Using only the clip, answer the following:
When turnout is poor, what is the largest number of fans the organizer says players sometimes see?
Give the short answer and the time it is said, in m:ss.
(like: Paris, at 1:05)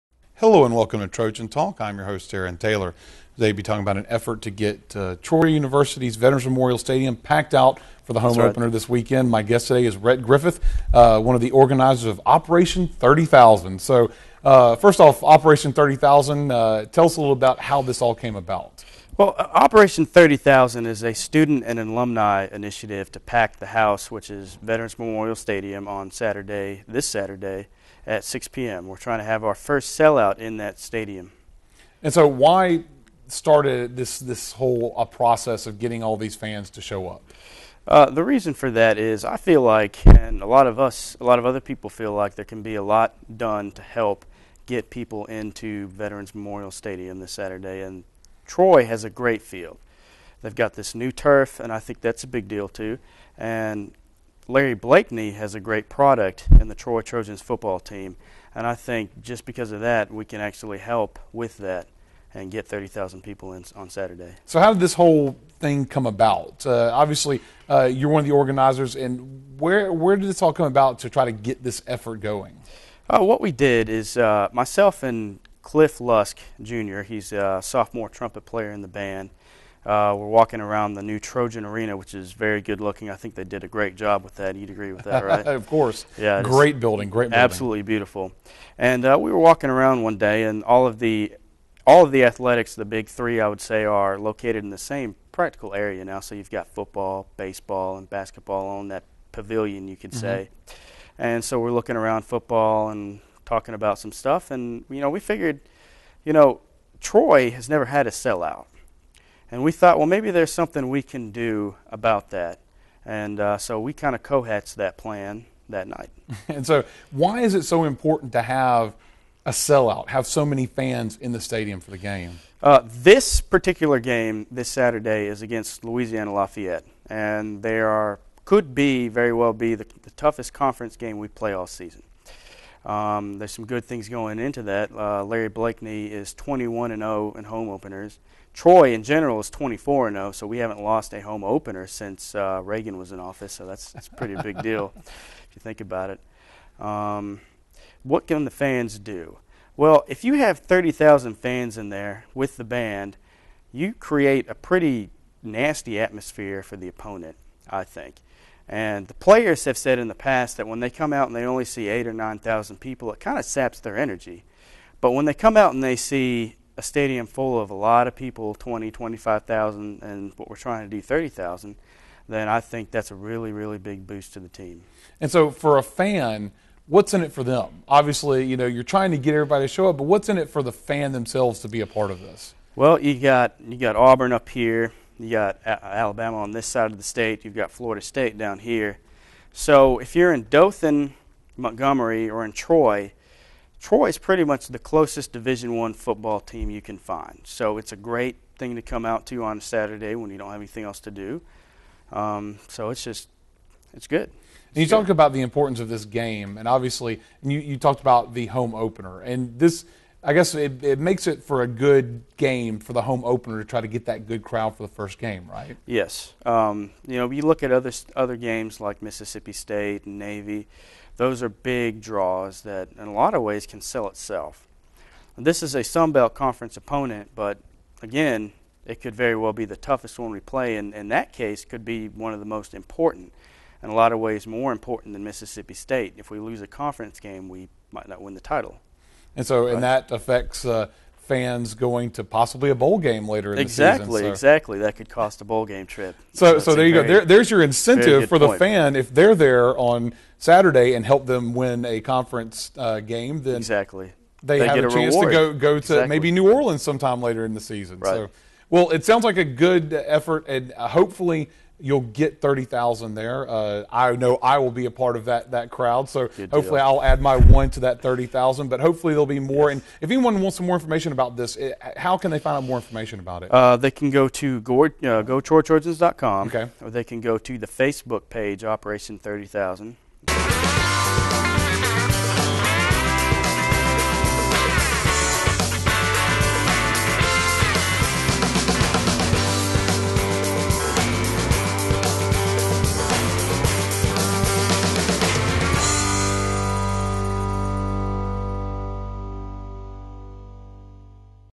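9,000, at 2:42.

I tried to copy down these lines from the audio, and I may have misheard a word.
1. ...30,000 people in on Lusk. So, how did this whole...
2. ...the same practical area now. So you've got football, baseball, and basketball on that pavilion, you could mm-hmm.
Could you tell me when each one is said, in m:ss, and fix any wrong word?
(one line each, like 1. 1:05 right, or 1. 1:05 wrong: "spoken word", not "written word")
1. 1:02 wrong: "Saturday", not "Lusk"
2. 1:34 right.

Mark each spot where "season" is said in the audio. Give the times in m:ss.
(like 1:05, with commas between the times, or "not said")
2:11, 4:03, 4:17.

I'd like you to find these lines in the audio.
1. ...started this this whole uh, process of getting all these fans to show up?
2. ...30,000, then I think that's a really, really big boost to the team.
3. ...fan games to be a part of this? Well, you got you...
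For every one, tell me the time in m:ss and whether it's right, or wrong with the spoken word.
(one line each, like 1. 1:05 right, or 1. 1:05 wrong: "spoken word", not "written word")
1. 0:33 right
2. 2:51 right
3. 3:00 wrong: "themselves", not "games".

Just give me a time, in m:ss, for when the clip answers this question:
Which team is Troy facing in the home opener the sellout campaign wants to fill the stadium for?
2:05.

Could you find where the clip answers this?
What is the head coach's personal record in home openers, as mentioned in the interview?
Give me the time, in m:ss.
2:16.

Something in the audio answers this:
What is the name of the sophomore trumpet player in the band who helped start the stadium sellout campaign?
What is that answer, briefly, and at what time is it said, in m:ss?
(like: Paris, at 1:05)
Cliff Lusk Jr., at 1:15.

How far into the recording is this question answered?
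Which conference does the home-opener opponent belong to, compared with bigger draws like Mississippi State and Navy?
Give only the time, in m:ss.
3:45.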